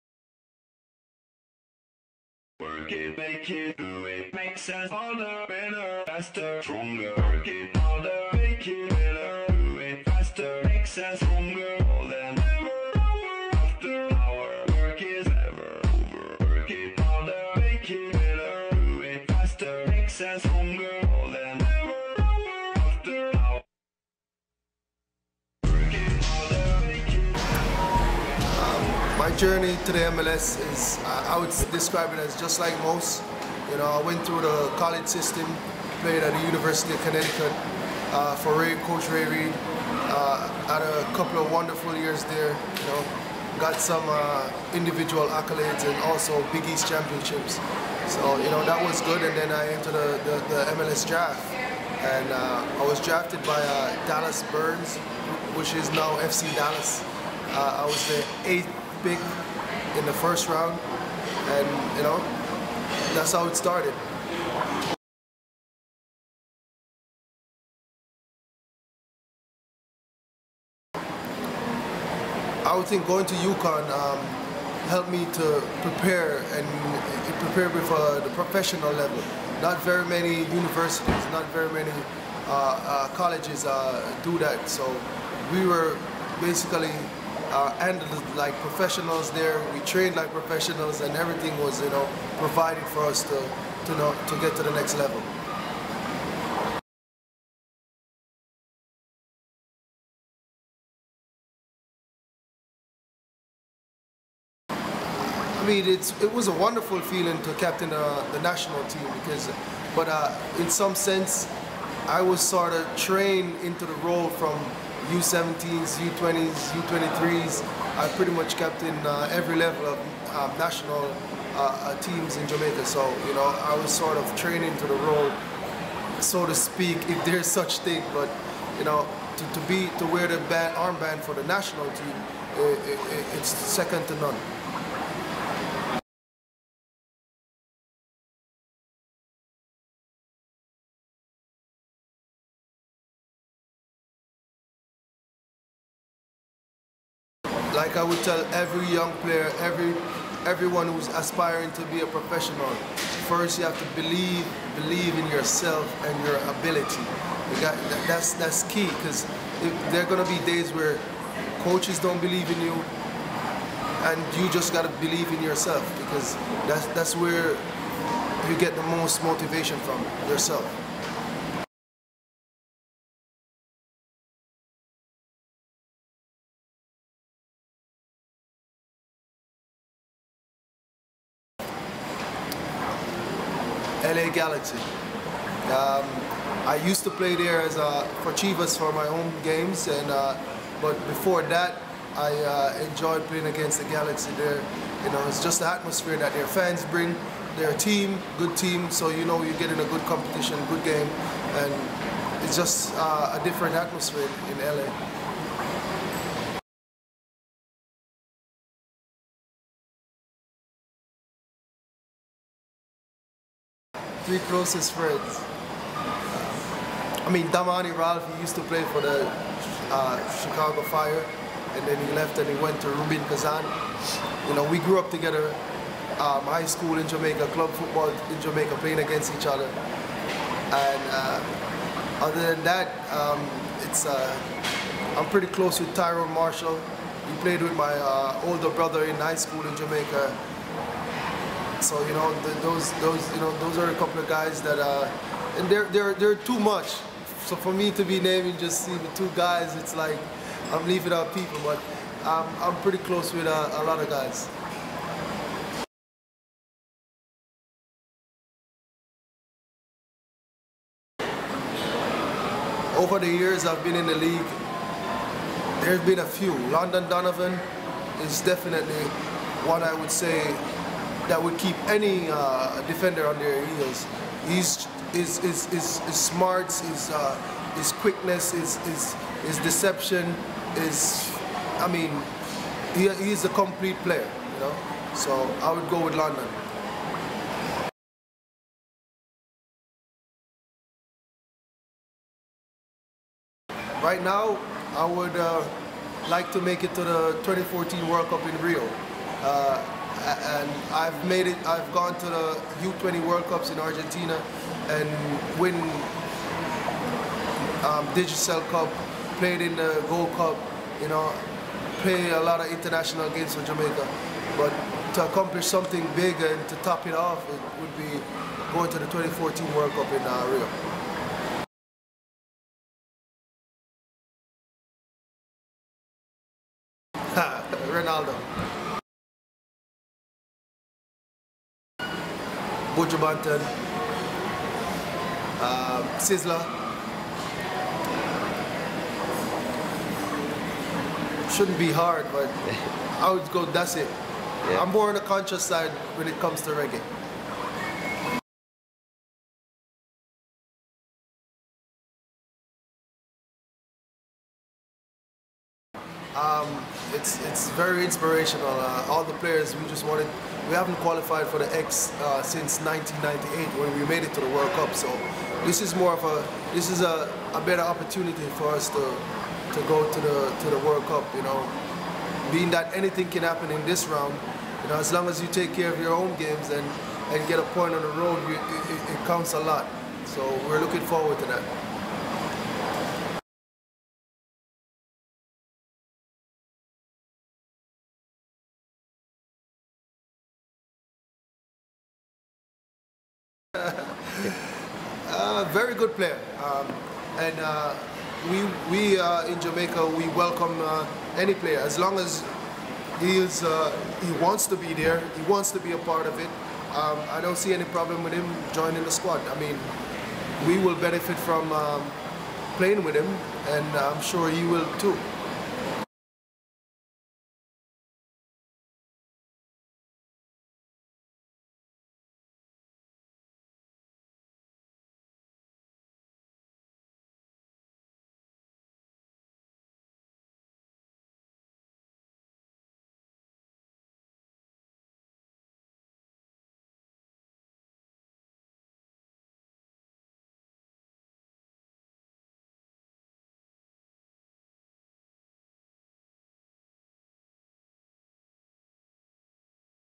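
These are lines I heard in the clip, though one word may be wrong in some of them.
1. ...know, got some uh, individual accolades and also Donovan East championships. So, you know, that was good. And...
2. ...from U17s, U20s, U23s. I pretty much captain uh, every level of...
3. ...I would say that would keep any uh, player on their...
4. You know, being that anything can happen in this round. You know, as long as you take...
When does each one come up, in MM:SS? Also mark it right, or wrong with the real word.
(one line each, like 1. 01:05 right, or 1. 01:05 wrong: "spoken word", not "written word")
1. 00:42 wrong: "Big", not "Donovan"
2. 01:54 right
3. 04:29 wrong: "defender", not "player"
4. 06:11 right.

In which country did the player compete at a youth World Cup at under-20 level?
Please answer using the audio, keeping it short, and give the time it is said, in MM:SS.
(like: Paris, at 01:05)
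Argentina, at 05:03.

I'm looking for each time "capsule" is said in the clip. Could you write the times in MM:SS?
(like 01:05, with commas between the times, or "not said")
not said.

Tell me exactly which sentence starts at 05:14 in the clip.
But to accomplish something big and to top it off, it would be going to the 2014 World Cup in uh, Rio.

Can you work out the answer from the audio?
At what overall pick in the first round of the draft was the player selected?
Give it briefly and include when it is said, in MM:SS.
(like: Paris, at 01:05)
8th, at 00:58.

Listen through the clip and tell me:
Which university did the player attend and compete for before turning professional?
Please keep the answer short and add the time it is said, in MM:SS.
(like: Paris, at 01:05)
University of Connecticut, at 00:36.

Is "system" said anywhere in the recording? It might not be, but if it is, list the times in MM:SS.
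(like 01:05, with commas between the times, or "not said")
00:35.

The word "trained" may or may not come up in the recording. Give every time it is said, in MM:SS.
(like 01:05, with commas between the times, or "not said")
01:29, 01:52, 02:04.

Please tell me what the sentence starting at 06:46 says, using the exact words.
Um, I don't see any problem with him joining the squad.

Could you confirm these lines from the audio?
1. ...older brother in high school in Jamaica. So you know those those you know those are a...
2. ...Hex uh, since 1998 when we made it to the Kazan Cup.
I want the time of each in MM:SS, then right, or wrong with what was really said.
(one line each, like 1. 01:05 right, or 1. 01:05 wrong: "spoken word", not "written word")
1. 03:58 right
2. 06:01 wrong: "World", not "Kazan".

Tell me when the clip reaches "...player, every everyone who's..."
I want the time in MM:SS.
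02:29.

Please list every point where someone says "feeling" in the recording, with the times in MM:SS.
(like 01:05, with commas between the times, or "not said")
01:47.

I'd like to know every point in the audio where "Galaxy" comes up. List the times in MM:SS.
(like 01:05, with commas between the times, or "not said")
03:04, 03:13.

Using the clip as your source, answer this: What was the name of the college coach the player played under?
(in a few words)
Ray Reid.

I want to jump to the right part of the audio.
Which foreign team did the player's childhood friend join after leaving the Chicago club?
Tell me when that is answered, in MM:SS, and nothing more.
03:42.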